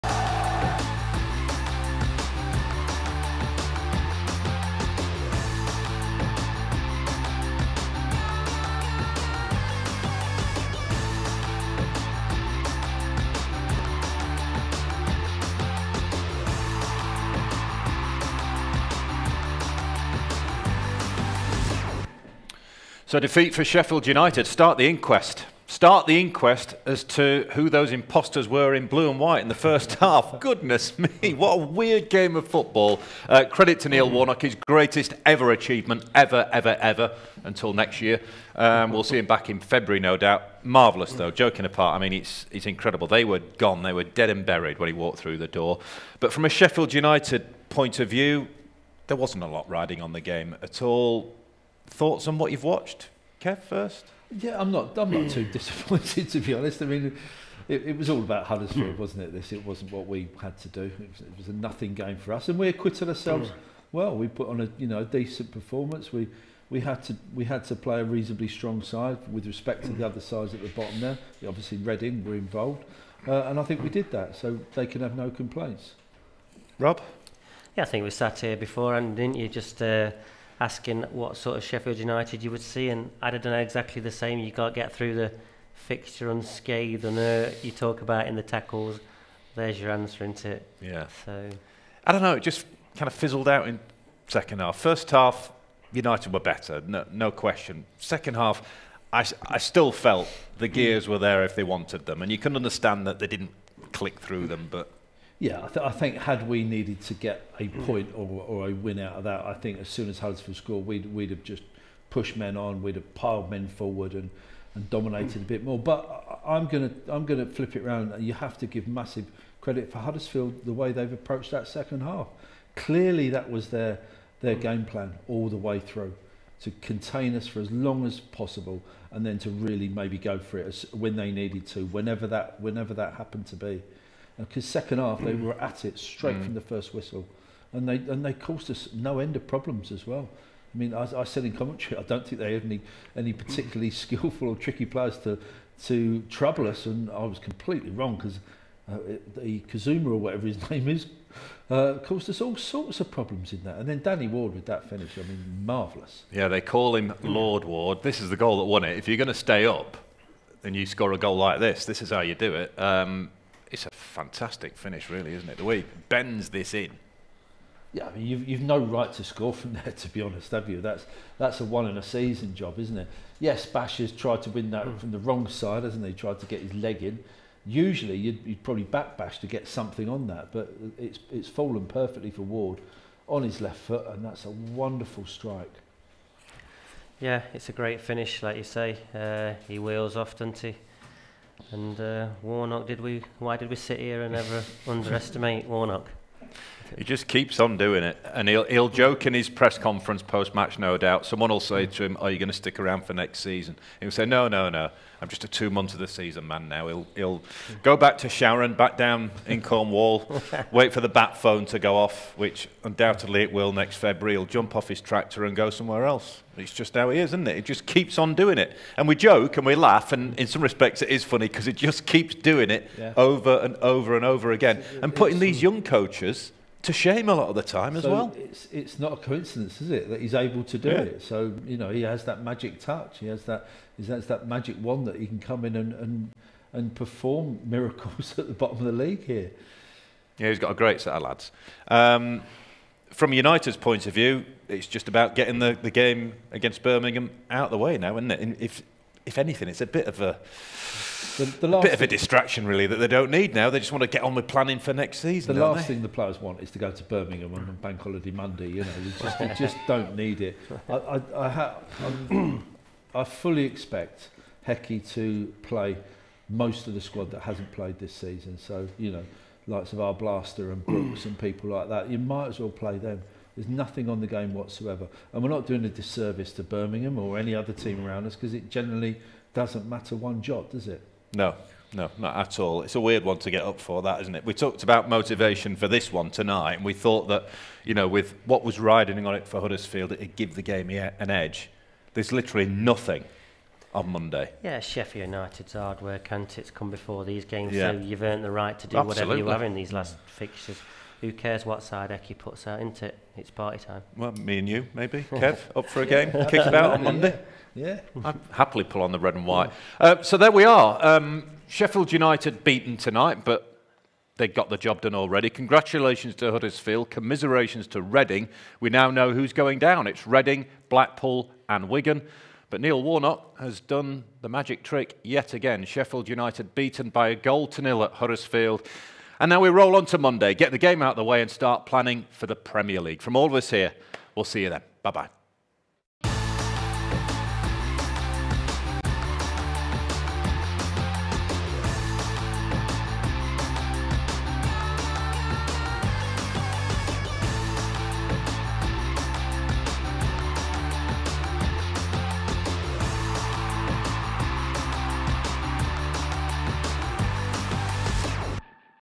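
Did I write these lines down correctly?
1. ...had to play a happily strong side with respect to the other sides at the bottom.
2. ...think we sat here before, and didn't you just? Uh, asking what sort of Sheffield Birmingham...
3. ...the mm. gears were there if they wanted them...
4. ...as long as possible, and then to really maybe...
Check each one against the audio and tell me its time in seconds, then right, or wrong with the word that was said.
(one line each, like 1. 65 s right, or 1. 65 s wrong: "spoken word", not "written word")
1. 67 s wrong: "reasonably", not "happily"
2. 77 s wrong: "United", not "Birmingham"
3. 100 s right
4. 127 s right.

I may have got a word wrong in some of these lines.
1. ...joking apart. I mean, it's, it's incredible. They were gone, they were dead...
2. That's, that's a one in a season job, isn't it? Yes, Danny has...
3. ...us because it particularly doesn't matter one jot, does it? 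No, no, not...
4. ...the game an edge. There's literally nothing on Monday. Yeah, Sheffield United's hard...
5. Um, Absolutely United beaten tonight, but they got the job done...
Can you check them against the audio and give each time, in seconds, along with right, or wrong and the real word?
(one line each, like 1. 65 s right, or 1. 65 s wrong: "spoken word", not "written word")
1. 41 s right
2. 170 s wrong: "Bash", not "Danny"
3. 278 s wrong: "generally", not "particularly"
4. 290 s right
5. 311 s wrong: "Sheffield", not "Absolutely".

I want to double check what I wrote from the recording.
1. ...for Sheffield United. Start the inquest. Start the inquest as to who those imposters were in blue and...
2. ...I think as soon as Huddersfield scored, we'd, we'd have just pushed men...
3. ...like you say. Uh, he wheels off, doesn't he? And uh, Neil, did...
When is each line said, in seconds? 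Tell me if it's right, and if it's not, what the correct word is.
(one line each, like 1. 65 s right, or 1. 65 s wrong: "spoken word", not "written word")
1. 23 s right
2. 109 s right
3. 188 s wrong: "Warnock", not "Neil".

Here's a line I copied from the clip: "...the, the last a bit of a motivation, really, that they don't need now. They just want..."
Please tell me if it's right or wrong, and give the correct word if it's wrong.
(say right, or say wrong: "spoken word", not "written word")
wrong: "distraction", not "motivation".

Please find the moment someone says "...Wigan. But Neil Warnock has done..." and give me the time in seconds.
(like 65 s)
321 s.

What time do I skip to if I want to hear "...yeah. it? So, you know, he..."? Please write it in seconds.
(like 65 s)
230 s.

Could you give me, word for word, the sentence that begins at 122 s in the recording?
Clearly, that was their their mm.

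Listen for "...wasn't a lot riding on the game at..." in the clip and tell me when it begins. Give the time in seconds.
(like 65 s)
49 s.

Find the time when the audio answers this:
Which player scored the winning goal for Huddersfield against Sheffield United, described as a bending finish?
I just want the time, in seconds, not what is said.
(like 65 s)
154 s.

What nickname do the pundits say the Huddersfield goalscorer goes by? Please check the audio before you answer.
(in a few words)
Lord Ward.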